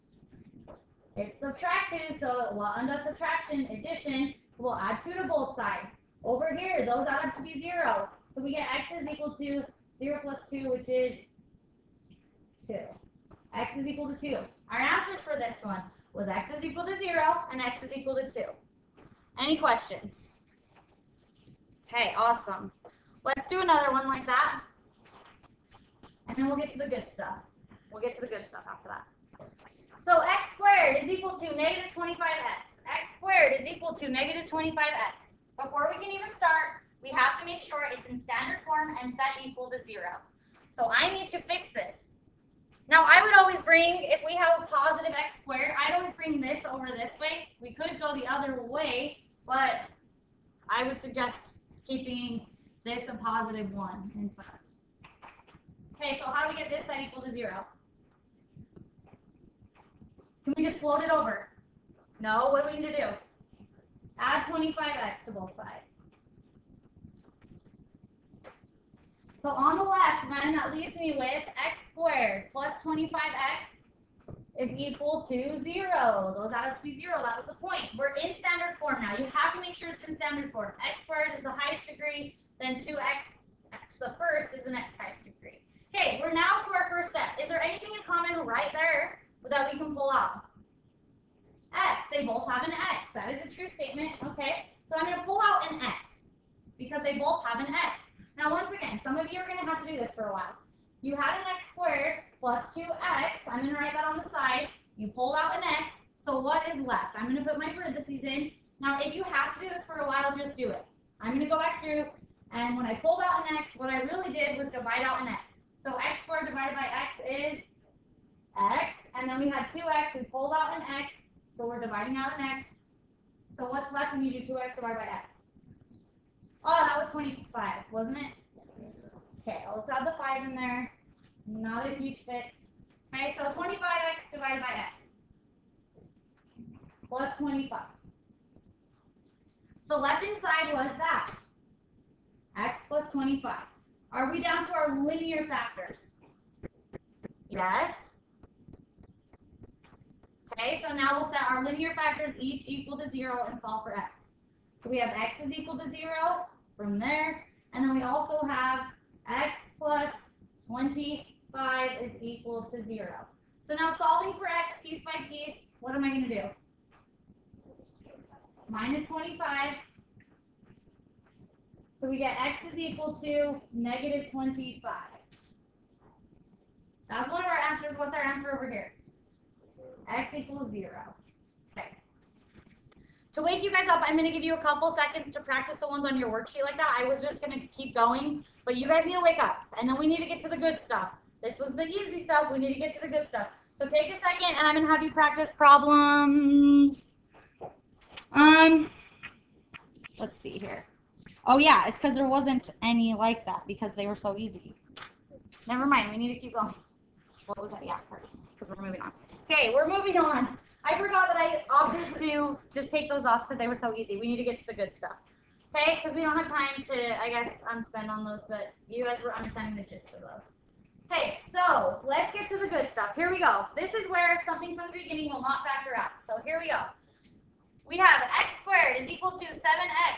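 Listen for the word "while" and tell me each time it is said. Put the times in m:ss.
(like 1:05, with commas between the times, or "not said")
1:40, 1:50.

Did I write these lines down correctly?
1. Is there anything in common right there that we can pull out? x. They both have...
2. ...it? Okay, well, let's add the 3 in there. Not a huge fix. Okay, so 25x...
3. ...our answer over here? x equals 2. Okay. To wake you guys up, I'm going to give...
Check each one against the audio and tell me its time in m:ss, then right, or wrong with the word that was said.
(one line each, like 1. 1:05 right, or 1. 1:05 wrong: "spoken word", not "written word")
1. 1:27 right
2. 2:08 wrong: "5", not "3"
3. 2:58 wrong: "0", not "2".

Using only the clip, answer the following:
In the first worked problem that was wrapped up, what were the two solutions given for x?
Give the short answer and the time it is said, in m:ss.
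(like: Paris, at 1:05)
0 and 2, at 0:16.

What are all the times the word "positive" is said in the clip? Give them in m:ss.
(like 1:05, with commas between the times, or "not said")
0:44, 0:53.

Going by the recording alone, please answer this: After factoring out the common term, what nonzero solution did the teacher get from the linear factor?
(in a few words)
-25.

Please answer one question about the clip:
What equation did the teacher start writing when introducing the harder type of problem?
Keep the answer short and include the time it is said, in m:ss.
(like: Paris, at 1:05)
x squared = 7x, at 3:48.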